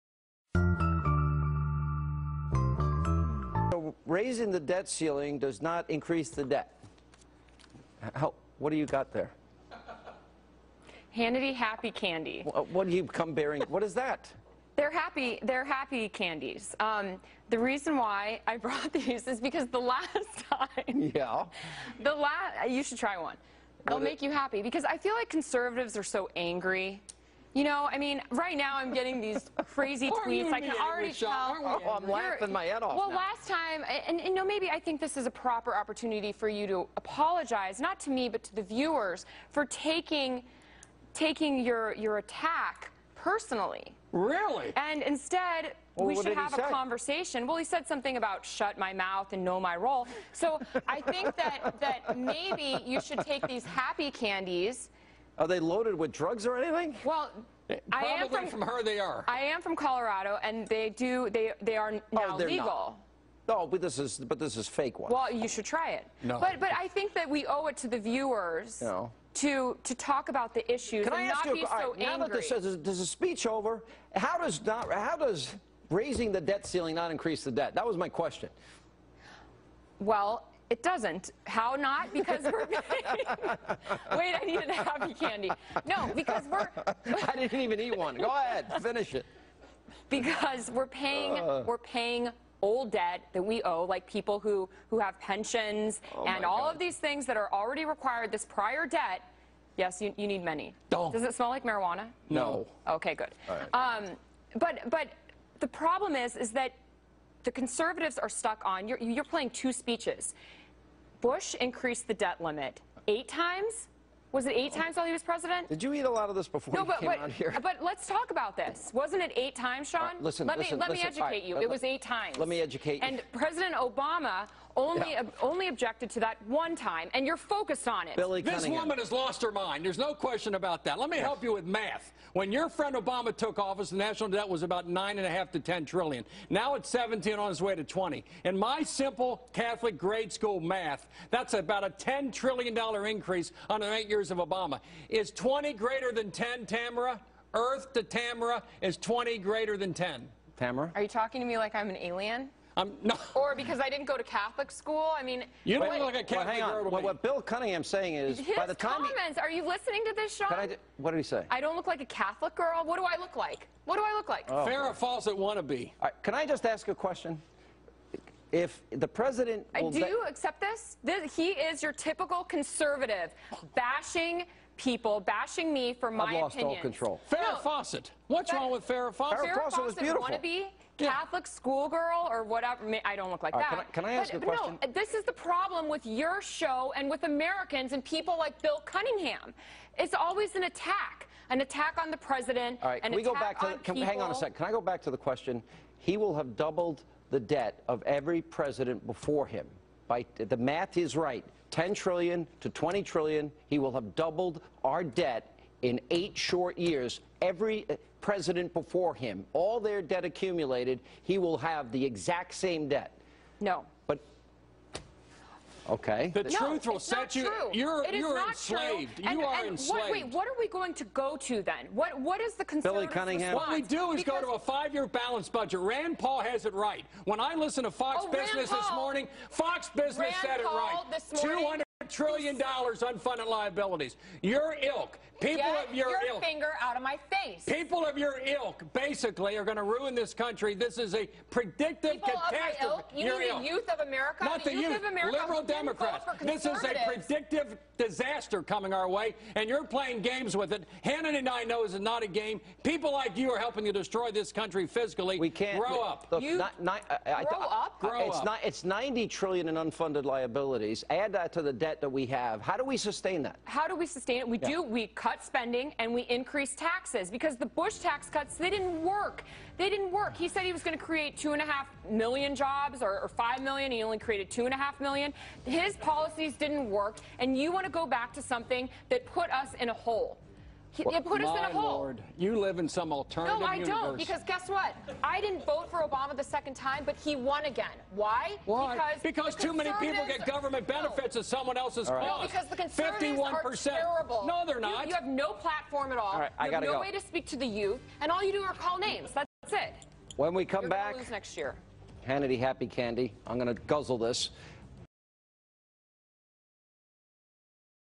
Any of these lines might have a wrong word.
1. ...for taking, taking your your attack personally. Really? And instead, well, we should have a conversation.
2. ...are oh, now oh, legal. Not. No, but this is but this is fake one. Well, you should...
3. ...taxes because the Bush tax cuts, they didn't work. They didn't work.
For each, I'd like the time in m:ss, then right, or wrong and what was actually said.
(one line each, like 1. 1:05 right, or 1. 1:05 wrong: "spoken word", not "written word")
1. 0:39 right
2. 1:01 right
3. 4:26 right.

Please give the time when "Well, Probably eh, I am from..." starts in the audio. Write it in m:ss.
0:57.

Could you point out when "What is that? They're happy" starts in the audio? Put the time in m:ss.
0:13.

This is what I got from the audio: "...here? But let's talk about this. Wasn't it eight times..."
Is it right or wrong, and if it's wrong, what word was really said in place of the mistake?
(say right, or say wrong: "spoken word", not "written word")
right.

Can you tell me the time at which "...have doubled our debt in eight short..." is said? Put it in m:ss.
3:23.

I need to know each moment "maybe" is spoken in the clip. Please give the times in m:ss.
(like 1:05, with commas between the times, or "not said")
0:34, 0:52.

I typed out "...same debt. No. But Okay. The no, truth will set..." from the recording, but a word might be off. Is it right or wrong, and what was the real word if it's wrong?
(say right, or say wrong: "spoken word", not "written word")
right.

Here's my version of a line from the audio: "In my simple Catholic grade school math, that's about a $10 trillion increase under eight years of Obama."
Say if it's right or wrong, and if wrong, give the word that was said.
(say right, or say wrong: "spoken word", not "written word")
right.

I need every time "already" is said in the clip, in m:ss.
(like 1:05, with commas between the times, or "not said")
0:30, 1:37.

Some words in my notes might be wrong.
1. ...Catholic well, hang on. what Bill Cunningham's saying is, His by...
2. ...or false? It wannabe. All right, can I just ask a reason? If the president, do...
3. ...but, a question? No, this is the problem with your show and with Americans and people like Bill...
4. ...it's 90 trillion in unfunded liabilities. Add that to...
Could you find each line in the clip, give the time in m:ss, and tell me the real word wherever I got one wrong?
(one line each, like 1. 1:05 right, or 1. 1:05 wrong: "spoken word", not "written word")
1. 2:36 right
2. 2:44 wrong: "question", not "reason"
3. 3:04 right
4. 4:18 right.